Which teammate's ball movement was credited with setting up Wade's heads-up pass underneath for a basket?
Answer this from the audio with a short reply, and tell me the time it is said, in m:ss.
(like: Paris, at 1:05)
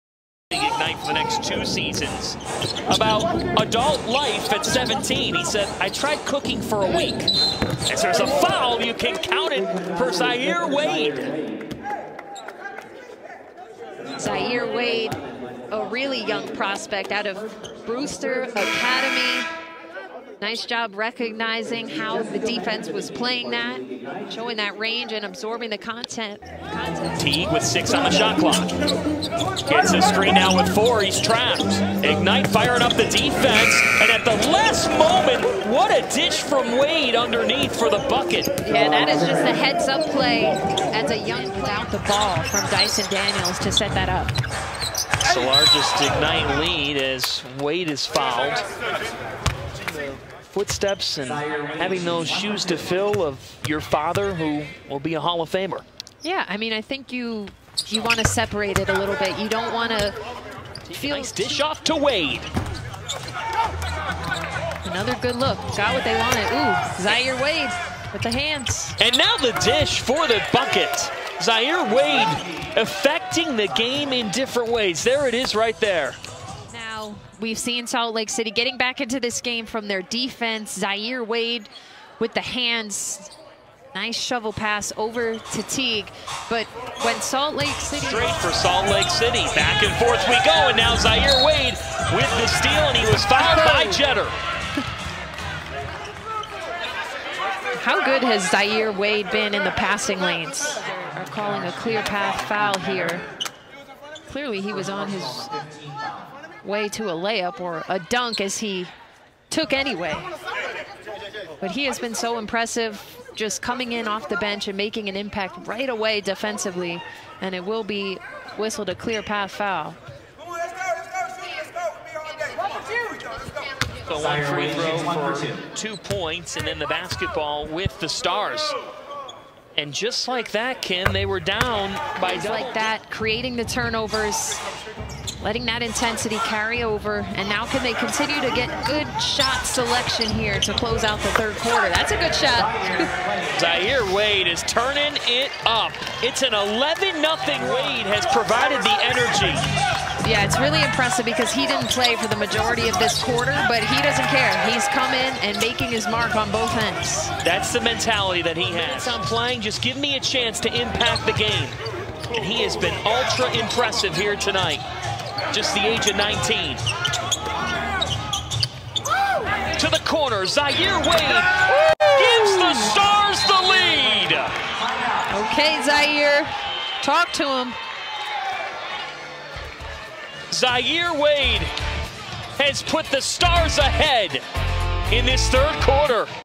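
Dyson Daniels, at 0:42.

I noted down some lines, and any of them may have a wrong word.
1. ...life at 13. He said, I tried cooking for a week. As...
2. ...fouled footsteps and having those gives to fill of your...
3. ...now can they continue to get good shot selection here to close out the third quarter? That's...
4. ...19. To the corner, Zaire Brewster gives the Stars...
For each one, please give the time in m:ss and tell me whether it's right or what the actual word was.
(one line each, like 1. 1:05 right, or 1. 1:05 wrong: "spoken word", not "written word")
1. 0:04 wrong: "17", not "13"
2. 0:48 wrong: "shoes", not "gives"
3. 2:17 right
4. 2:46 wrong: "Wade", not "Brewster".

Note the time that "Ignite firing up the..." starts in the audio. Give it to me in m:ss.
0:32.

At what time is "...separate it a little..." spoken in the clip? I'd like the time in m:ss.
0:58.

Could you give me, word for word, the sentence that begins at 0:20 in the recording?
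Nice job recognizing how the defense was playing that, showing that range and absorbing the content.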